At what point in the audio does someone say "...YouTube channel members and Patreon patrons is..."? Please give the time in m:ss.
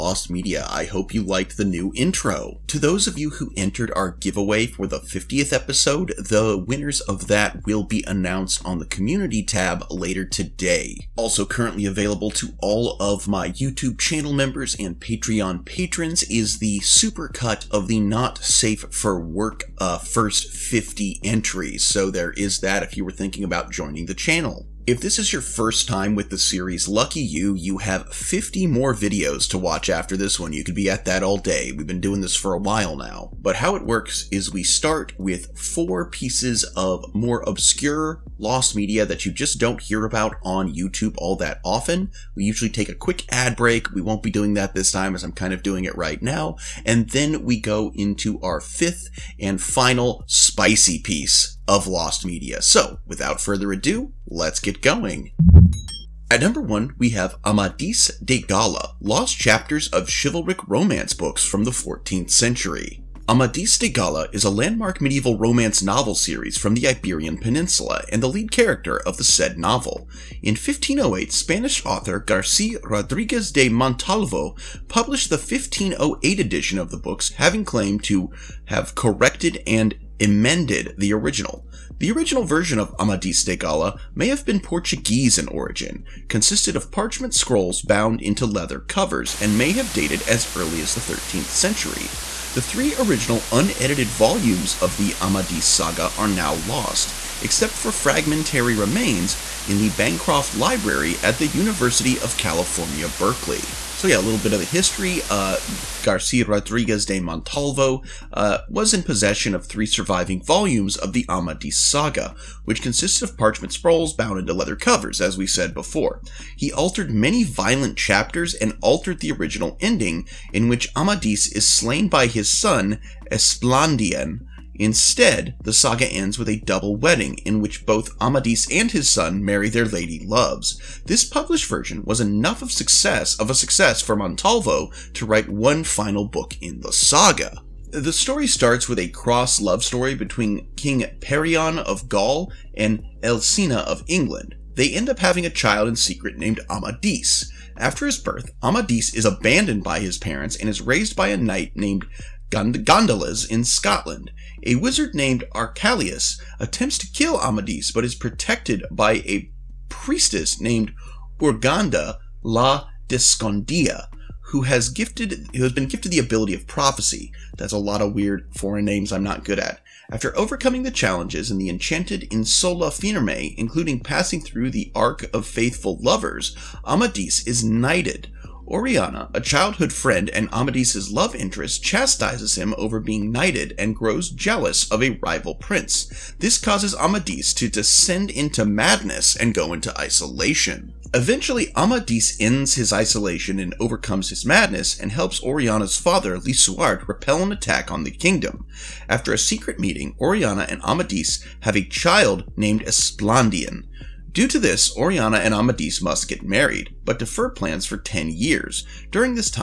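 0:13.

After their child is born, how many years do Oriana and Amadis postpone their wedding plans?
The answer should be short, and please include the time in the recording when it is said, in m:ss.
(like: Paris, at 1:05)
10, at 3:27.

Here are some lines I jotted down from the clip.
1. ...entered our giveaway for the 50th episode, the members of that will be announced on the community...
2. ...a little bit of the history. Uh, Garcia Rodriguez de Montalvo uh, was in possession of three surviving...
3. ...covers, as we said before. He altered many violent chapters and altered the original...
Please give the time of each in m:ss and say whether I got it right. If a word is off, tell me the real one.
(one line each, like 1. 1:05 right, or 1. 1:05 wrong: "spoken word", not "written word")
1. 0:03 wrong: "winners", not "members"
2. 1:44 right
3. 1:54 right.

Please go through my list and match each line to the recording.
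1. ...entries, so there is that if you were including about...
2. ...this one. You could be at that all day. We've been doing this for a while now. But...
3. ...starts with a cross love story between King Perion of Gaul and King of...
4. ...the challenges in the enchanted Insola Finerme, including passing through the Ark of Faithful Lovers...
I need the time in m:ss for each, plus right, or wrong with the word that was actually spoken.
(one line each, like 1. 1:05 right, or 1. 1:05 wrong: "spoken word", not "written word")
1. 0:21 wrong: "thinking", not "including"
2. 0:30 right
3. 2:18 wrong: "Elsina", not "King"
4. 2:50 right.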